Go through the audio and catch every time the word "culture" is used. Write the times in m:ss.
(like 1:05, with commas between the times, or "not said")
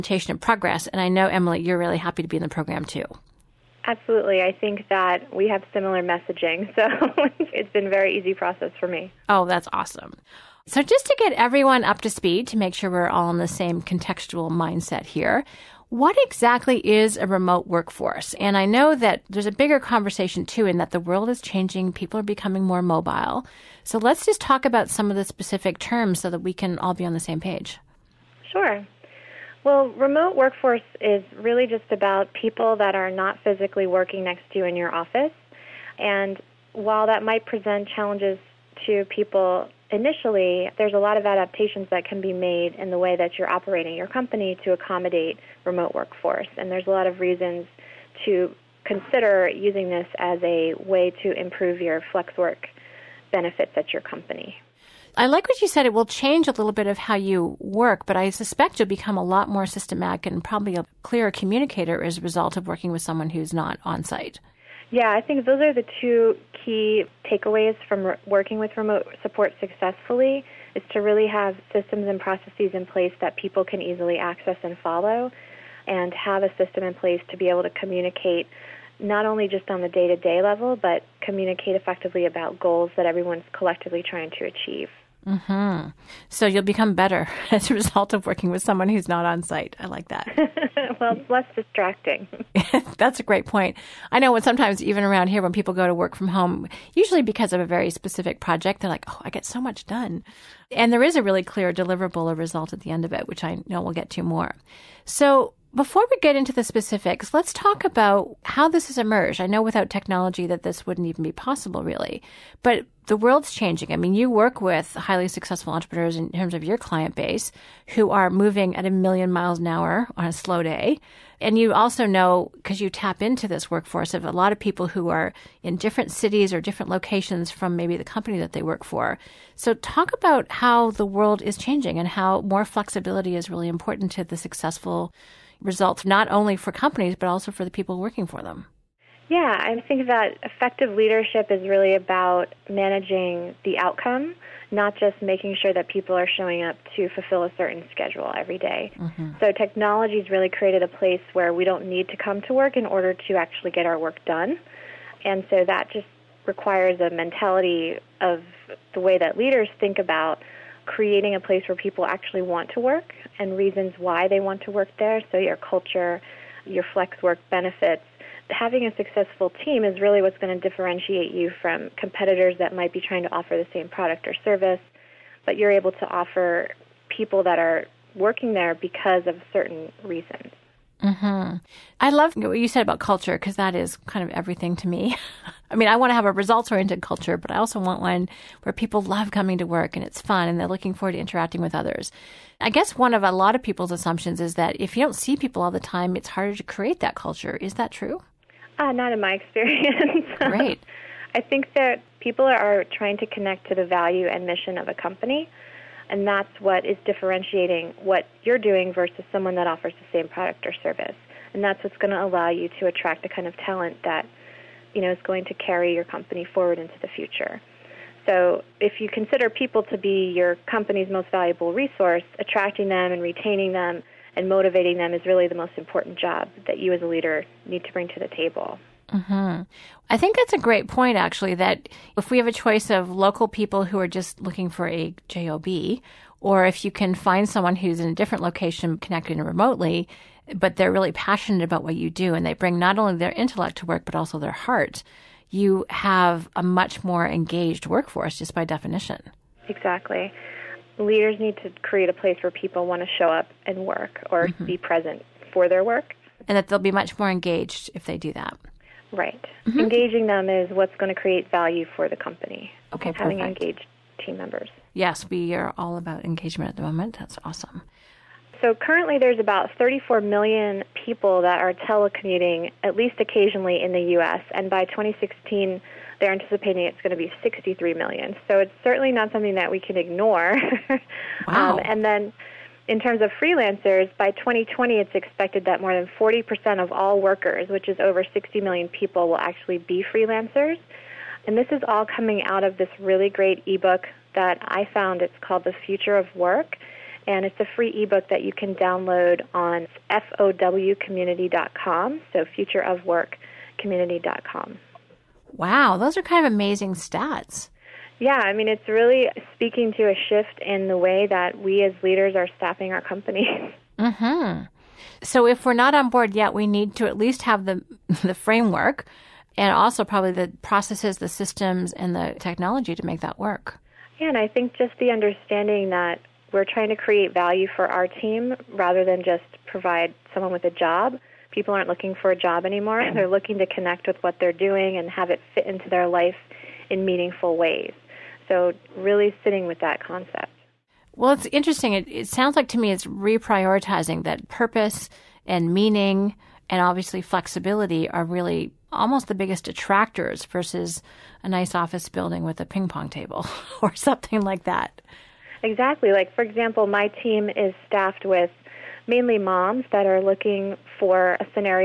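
2:45, 3:02, 3:07, 3:17.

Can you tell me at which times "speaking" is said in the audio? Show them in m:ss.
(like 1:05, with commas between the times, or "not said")
5:09.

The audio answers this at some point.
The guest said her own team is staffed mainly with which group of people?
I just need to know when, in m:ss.
5:59.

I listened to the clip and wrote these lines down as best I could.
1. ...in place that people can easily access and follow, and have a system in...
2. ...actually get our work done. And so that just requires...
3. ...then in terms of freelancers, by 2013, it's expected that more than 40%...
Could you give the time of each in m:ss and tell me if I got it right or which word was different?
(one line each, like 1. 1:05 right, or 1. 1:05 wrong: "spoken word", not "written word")
1. 1:12 right
2. 2:33 right
3. 4:42 wrong: "2020", not "2013".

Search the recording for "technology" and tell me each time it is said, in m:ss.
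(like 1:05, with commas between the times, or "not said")
1:49, 2:29, 5:22.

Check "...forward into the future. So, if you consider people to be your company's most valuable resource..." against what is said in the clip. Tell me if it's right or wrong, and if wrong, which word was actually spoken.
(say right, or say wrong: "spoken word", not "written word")
right.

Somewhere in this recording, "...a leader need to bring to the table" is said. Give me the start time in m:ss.
3:47.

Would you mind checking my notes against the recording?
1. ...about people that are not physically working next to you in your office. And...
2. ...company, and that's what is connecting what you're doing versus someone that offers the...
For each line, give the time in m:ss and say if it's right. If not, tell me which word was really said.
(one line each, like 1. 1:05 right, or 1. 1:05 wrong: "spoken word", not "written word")
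1. 0:31 right
2. 3:24 wrong: "differentiating", not "connecting".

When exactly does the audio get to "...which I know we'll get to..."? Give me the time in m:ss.
1:43.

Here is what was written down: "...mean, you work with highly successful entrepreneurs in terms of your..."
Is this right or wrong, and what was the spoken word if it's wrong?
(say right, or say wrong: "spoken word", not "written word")
right.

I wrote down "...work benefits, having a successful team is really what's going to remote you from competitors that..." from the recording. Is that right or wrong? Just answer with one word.
wrong.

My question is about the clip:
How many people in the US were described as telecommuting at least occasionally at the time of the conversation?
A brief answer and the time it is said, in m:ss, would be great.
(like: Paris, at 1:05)
34 million, at 4:29.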